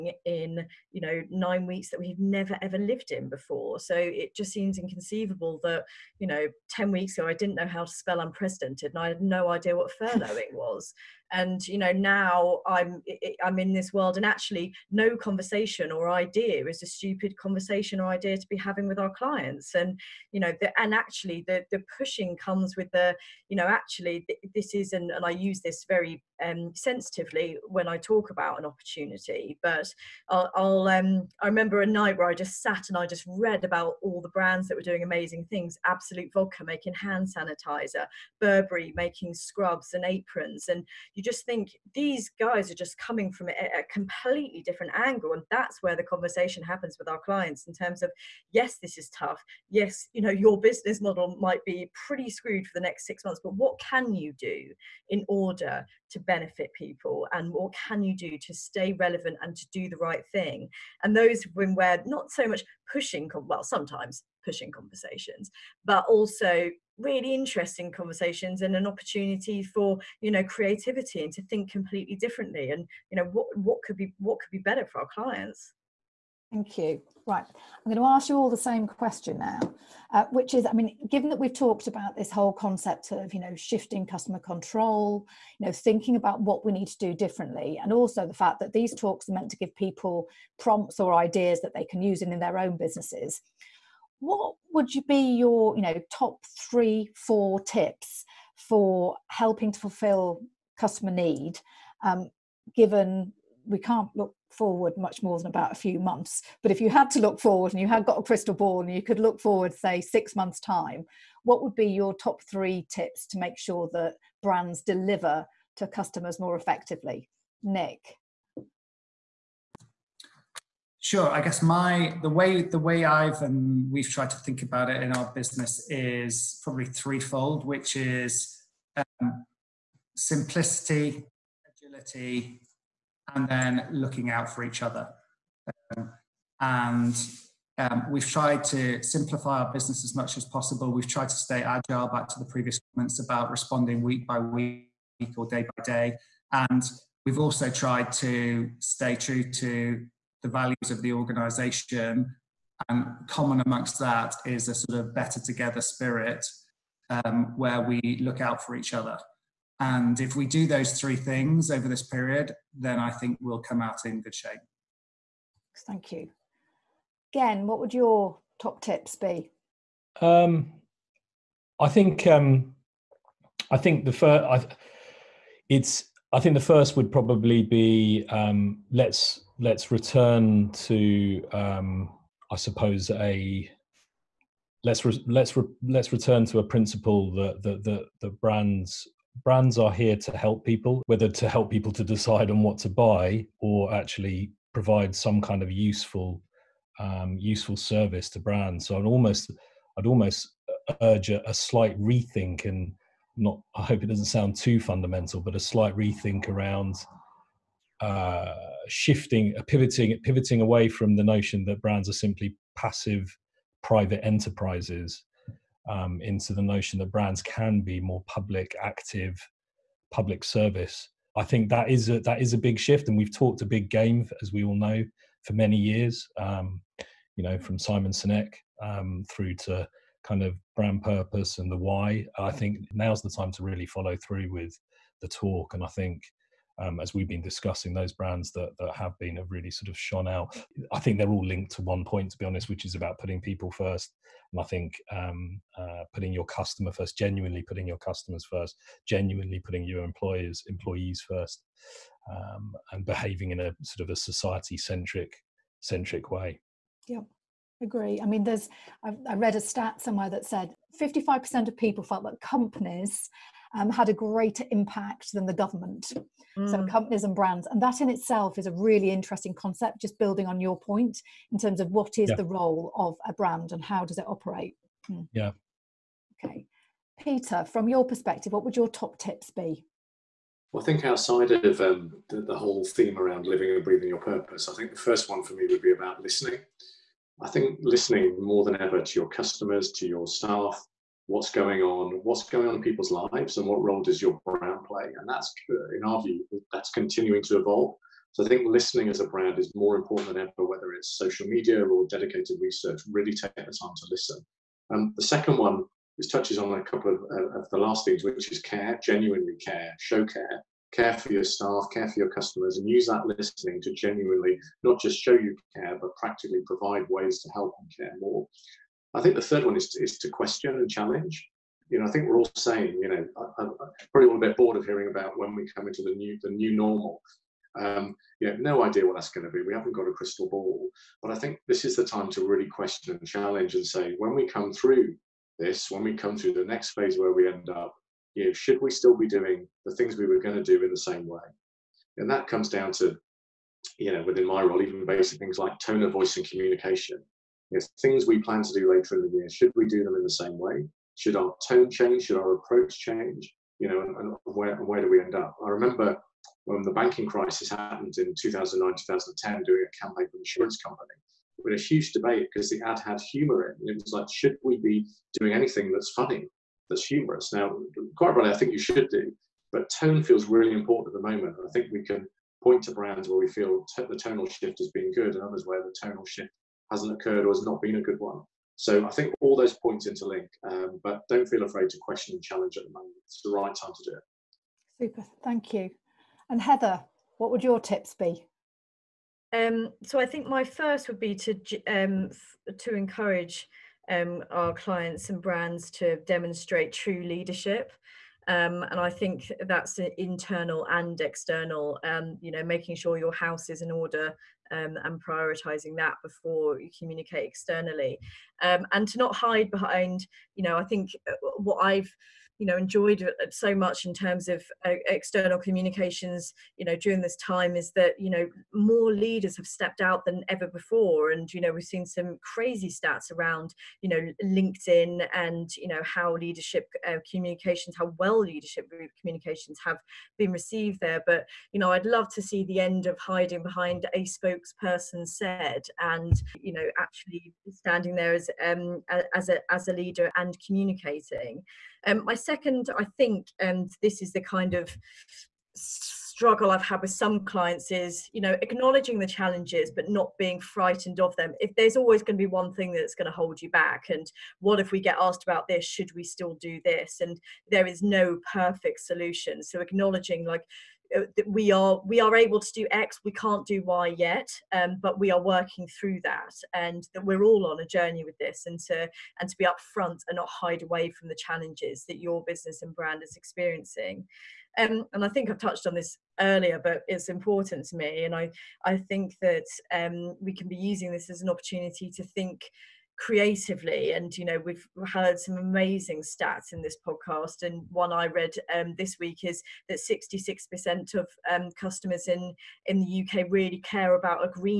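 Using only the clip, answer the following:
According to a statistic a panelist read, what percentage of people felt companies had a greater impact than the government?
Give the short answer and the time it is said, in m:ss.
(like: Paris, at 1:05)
55%, at 4:20.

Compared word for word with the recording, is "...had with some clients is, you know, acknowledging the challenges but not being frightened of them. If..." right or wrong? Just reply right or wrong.
right.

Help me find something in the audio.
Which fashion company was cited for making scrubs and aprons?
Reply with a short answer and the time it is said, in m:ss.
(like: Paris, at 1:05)
Burberry, at 0:38.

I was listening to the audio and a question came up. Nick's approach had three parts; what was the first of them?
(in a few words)
Simplicity.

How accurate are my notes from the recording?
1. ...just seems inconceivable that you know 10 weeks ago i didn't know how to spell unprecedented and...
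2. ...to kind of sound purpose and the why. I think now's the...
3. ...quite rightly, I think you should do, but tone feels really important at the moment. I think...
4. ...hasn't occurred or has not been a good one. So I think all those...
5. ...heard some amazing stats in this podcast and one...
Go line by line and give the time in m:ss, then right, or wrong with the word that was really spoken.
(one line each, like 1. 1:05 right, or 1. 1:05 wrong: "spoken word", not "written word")
1. 0:04 right
2. 3:49 wrong: "brand", not "sound"
3. 6:08 right
4. 6:16 right
5. 8:05 right.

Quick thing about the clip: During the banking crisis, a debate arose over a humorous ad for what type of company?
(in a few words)
An insurance company.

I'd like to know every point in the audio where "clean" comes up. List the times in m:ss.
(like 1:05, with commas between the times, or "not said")
not said.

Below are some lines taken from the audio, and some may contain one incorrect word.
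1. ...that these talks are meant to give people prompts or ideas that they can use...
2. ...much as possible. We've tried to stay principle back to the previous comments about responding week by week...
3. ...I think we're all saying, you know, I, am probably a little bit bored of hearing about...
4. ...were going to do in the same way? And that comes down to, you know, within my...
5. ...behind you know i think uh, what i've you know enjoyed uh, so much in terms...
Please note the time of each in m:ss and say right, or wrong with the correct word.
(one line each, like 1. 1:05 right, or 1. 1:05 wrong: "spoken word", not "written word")
1. 1:28 right
2. 2:20 wrong: "agile", not "principle"
3. 5:22 right
4. 5:40 right
5. 6:49 right.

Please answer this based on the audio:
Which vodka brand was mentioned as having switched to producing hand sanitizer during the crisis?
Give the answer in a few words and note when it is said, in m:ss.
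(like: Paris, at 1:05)
Absolut, at 0:35.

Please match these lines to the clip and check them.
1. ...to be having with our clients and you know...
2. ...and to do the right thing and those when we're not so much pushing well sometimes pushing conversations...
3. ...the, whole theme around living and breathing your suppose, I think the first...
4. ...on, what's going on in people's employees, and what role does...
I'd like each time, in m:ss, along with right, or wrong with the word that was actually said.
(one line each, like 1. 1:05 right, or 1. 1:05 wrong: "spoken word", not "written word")
1. 0:18 right
2. 0:59 right
3. 4:42 wrong: "purpose", not "suppose"
4. 4:51 wrong: "lives", not "employees".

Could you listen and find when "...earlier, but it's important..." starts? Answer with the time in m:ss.
7:56.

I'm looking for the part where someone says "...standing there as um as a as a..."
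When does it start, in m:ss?
7:17.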